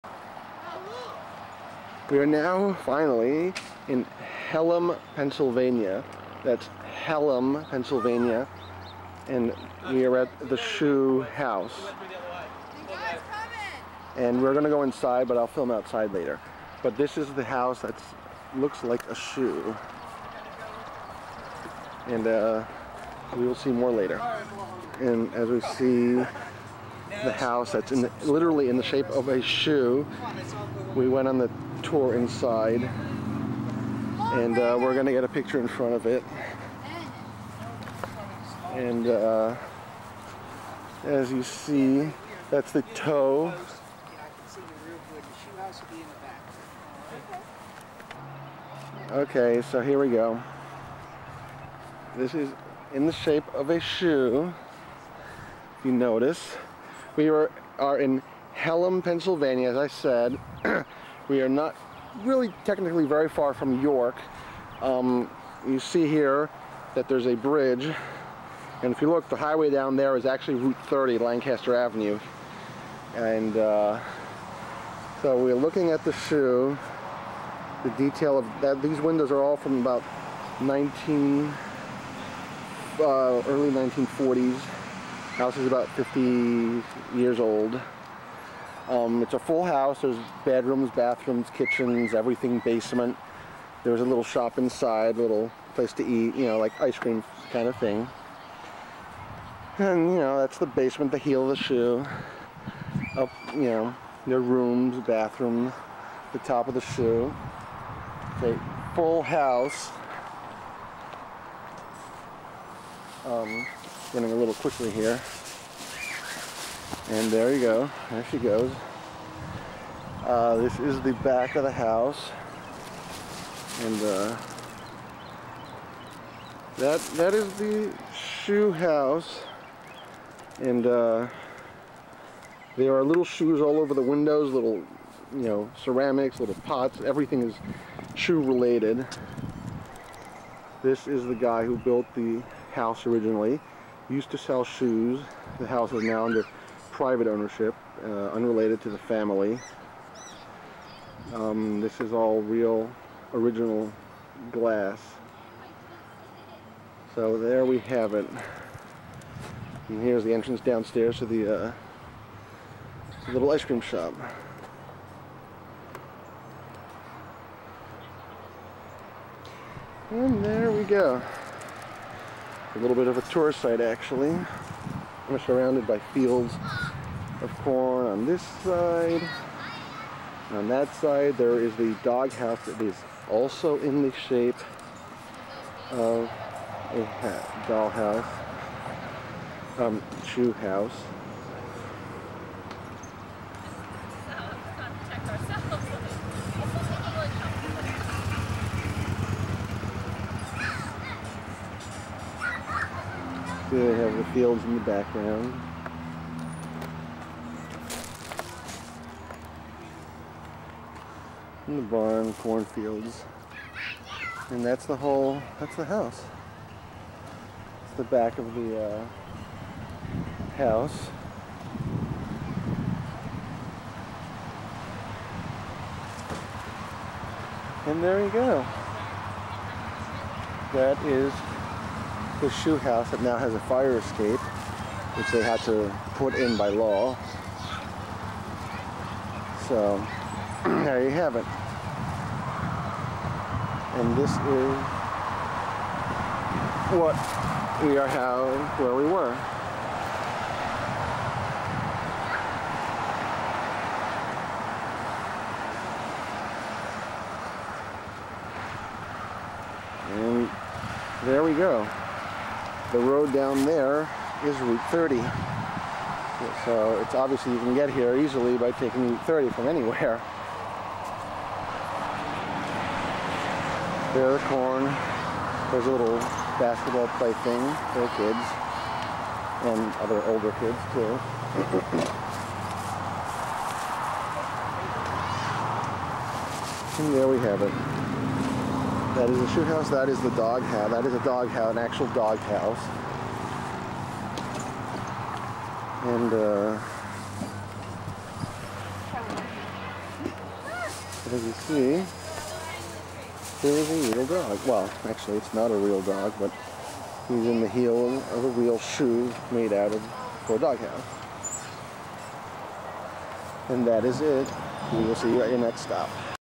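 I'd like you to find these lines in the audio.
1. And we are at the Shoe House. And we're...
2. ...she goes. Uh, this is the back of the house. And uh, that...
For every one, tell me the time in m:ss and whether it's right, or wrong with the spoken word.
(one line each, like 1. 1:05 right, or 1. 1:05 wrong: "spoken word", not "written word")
1. 0:09 right
2. 1:58 right.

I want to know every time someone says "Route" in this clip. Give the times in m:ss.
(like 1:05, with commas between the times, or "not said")
1:10, 4:24, 4:29.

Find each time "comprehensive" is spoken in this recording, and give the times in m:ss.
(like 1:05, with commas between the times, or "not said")
not said.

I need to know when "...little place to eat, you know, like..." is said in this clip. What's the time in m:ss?
1:35.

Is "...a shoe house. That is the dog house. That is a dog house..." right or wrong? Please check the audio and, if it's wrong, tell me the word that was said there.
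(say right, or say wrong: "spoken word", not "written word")
right.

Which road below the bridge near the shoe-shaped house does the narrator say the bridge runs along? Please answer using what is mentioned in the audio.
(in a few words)
Lancaster Avenue.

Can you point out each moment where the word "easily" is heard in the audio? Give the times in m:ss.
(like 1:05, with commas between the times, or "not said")
4:28.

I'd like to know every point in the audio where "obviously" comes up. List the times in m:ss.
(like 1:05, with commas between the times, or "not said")
4:27.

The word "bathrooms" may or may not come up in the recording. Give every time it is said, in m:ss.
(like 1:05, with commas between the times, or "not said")
1:30, 1:45.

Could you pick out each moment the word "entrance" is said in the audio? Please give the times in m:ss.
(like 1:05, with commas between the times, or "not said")
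2:40.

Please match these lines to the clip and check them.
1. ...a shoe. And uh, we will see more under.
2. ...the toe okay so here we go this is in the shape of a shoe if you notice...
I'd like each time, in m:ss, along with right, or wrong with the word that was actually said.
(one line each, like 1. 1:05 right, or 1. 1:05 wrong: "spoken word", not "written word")
1. 0:19 wrong: "later", not "under"
2. 0:42 right.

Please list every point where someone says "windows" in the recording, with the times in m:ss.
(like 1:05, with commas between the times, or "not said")
1:18, 2:14.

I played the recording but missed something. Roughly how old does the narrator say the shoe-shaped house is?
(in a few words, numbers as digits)
about 50 years old.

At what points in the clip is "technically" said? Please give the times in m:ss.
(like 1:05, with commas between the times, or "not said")
1:02.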